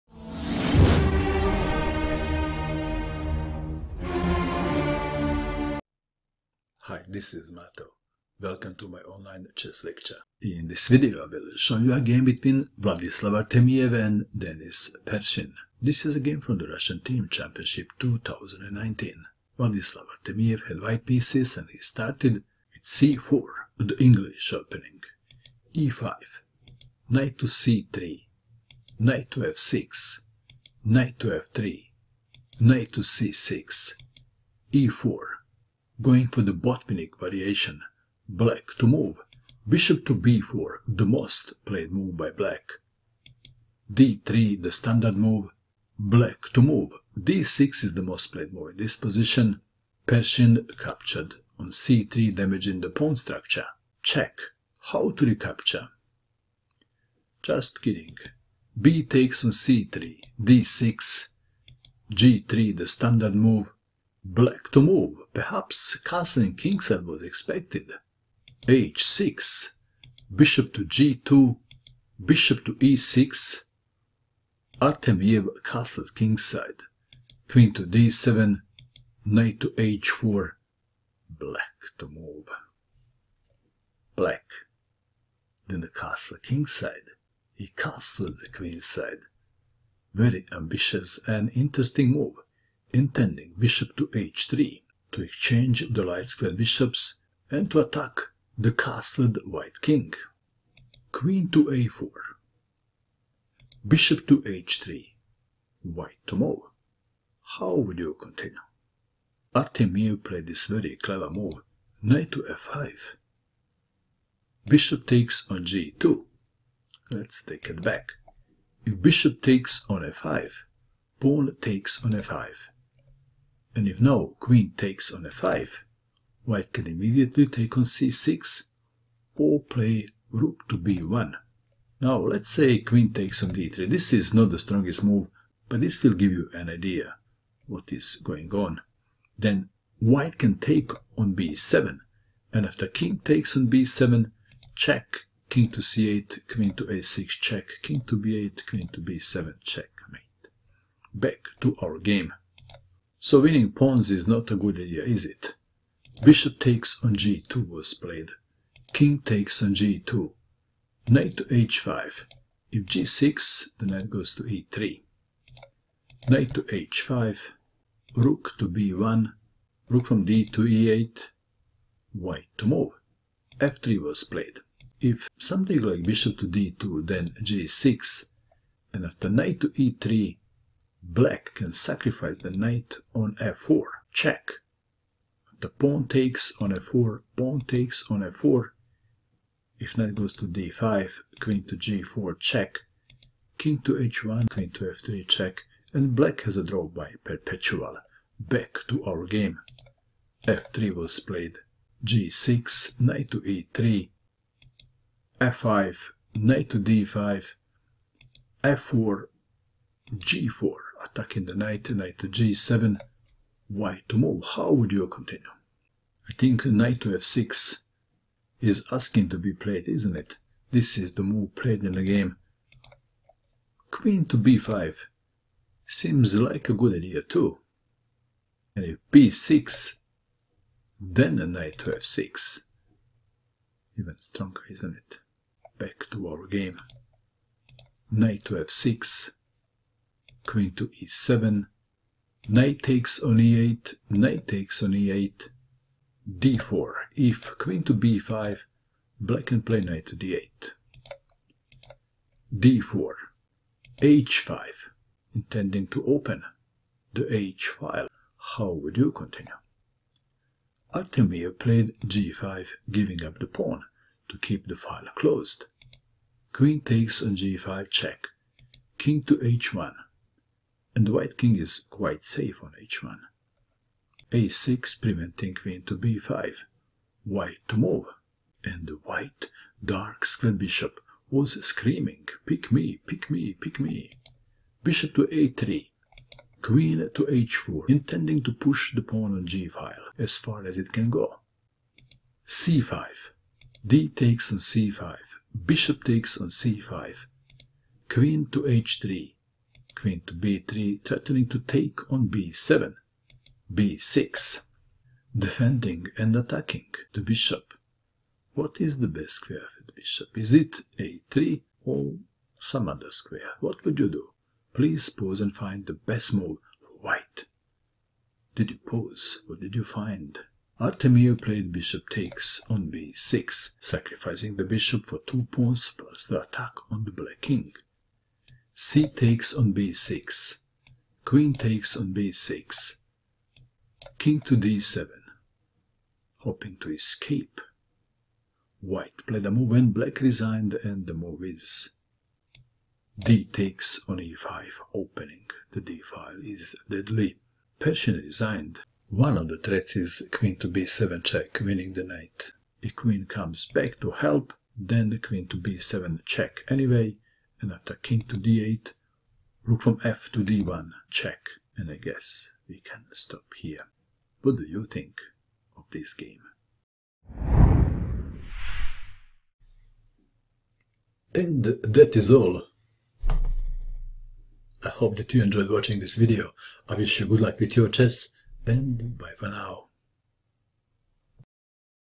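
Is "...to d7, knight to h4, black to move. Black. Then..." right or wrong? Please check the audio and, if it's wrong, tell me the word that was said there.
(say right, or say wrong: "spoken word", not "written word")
right.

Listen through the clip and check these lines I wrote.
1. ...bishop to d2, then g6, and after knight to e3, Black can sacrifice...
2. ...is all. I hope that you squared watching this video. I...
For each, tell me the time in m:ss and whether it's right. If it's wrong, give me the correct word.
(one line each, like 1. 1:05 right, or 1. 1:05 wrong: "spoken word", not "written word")
1. 2:56 right
2. 6:12 wrong: "enjoyed", not "squared".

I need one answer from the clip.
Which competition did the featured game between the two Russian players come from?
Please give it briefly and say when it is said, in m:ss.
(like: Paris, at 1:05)
Russian Team Championship 2019, at 0:16.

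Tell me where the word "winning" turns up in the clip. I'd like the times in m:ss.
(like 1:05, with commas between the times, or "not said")
2:33, 5:51.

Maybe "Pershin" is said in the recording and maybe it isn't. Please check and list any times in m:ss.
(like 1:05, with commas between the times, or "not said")
0:15, 0:50, 5:47.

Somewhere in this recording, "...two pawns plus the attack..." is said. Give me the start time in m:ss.
5:25.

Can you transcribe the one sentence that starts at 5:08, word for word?
What is the best square for the bishop?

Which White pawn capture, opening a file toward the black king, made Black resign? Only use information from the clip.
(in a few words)
d takes on e5.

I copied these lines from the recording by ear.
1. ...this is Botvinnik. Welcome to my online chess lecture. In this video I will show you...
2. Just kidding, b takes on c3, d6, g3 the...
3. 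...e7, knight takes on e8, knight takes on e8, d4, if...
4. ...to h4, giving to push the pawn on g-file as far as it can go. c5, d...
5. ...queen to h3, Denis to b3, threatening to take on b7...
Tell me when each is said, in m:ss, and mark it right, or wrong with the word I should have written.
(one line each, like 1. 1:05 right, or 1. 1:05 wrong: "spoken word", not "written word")
1. 0:07 wrong: "Mato", not "Botvinnik"
2. 0:57 right
3. 4:00 right
4. 4:47 wrong: "intending", not "giving"
5. 4:58 wrong: "Queen", not "Denis".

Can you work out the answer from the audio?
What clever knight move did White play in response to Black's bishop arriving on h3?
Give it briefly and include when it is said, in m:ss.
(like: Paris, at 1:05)
Knight to f5, at 1:52.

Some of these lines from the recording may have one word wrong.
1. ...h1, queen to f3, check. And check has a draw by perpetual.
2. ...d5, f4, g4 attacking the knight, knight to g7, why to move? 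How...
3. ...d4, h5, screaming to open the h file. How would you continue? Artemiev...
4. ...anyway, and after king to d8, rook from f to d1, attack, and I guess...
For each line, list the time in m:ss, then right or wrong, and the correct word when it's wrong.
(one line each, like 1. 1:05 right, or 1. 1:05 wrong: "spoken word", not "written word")
1. 3:13 wrong: "black", not "check"
2. 3:26 right
3. 4:12 wrong: "intending", not "screaming"
4. 5:56 wrong: "check", not "attack".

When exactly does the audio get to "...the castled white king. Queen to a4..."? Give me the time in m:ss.
1:38.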